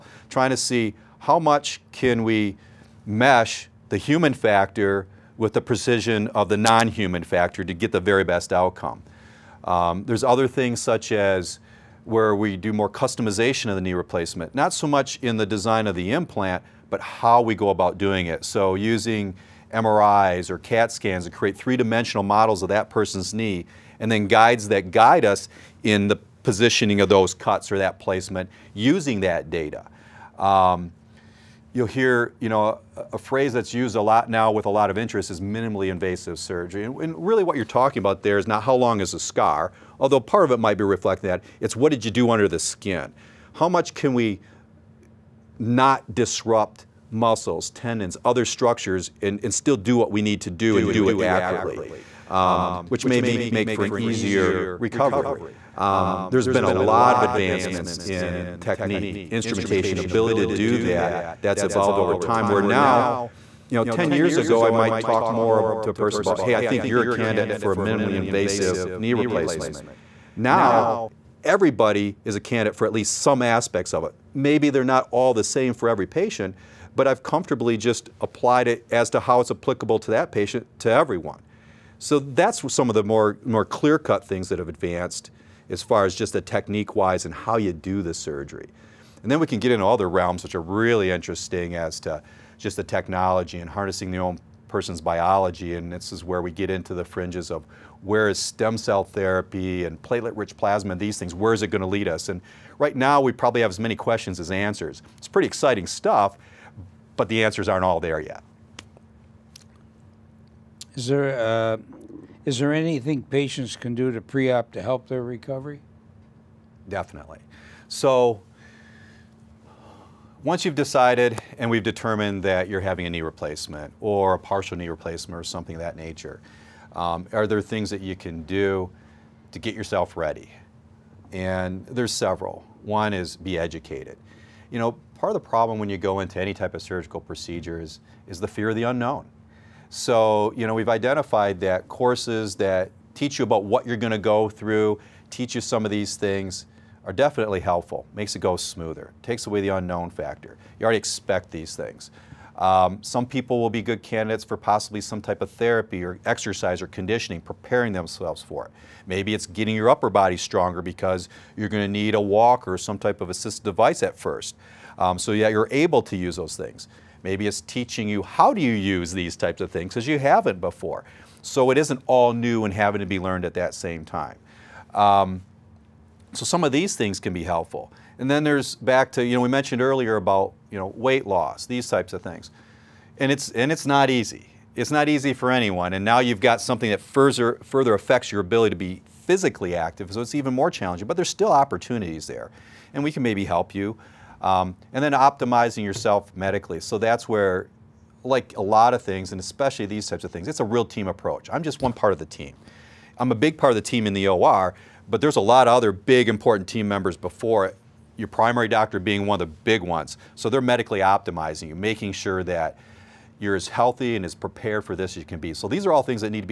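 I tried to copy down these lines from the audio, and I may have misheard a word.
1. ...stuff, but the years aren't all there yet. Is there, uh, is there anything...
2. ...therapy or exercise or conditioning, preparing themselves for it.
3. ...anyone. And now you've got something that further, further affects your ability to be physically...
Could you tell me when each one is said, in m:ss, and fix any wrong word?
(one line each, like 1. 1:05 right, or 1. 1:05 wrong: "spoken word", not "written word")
1. 1:45 wrong: "answers", not "years"
2. 2:35 right
3. 3:05 right.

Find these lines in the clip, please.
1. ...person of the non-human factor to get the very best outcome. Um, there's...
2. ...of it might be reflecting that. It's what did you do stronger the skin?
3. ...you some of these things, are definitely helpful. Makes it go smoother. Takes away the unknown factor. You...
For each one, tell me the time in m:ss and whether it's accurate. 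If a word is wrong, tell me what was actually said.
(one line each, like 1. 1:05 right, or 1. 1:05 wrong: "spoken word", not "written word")
1. 0:05 wrong: "precision", not "person"
2. 0:40 wrong: "under", not "stronger"
3. 2:25 right.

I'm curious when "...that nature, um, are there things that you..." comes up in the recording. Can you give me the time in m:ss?
2:05.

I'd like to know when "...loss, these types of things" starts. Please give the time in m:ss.
3:01.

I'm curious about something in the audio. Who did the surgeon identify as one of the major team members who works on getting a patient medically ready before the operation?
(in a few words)
primary doctor.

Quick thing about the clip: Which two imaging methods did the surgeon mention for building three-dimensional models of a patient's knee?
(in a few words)
MRIs or CAT scans.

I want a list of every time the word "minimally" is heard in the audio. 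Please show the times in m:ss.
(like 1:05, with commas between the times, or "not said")
0:35, 1:07.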